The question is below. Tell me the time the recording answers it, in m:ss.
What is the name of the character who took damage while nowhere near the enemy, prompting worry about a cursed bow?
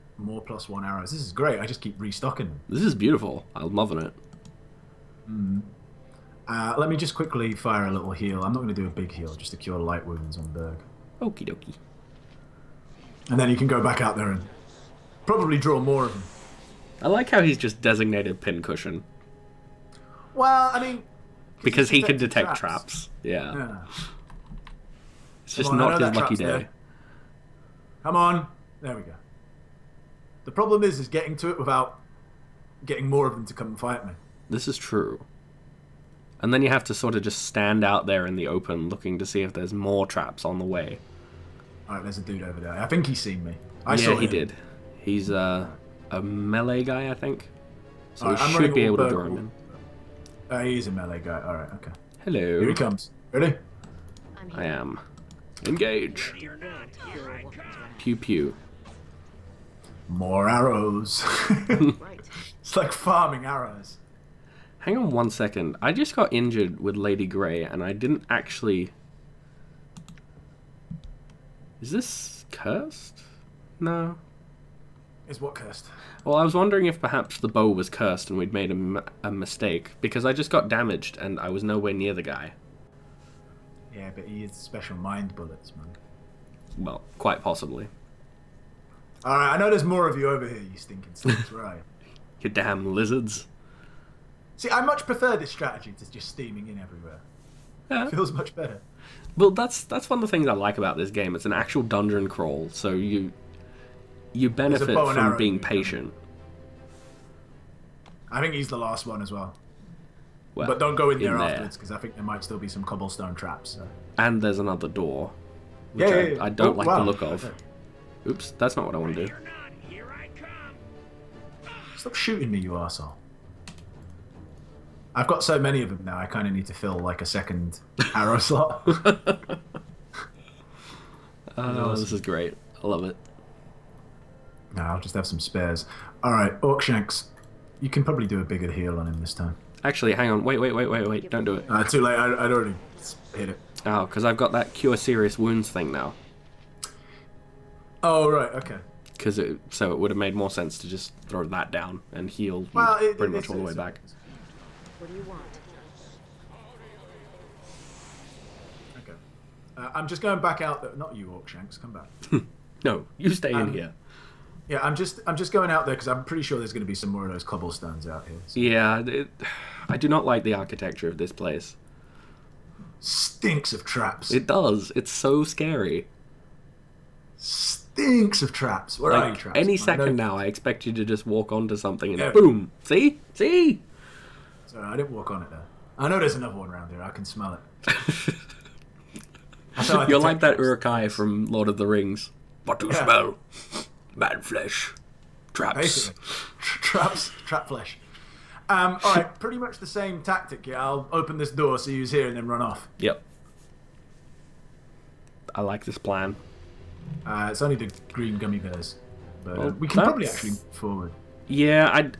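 1:06.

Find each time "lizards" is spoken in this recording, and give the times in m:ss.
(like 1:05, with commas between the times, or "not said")
1:32.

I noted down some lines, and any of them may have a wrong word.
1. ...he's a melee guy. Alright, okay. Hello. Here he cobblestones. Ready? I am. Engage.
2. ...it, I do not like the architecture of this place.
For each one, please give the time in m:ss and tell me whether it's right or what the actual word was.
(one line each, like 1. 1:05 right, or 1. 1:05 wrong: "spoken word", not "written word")
1. 0:50 wrong: "comes", not "cobblestones"
2. 2:48 right.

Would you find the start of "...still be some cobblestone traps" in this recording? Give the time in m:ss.
1:52.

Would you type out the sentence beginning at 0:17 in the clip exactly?
I like how he's just designated pincushion.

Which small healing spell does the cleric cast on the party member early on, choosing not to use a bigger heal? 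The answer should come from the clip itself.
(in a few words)
Cure light wounds.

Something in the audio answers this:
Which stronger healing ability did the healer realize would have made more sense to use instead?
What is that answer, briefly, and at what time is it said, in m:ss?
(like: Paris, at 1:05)
Cure serious wounds, at 2:24.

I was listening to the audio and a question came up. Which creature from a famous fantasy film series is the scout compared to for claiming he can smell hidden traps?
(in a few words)
Uruk-hai.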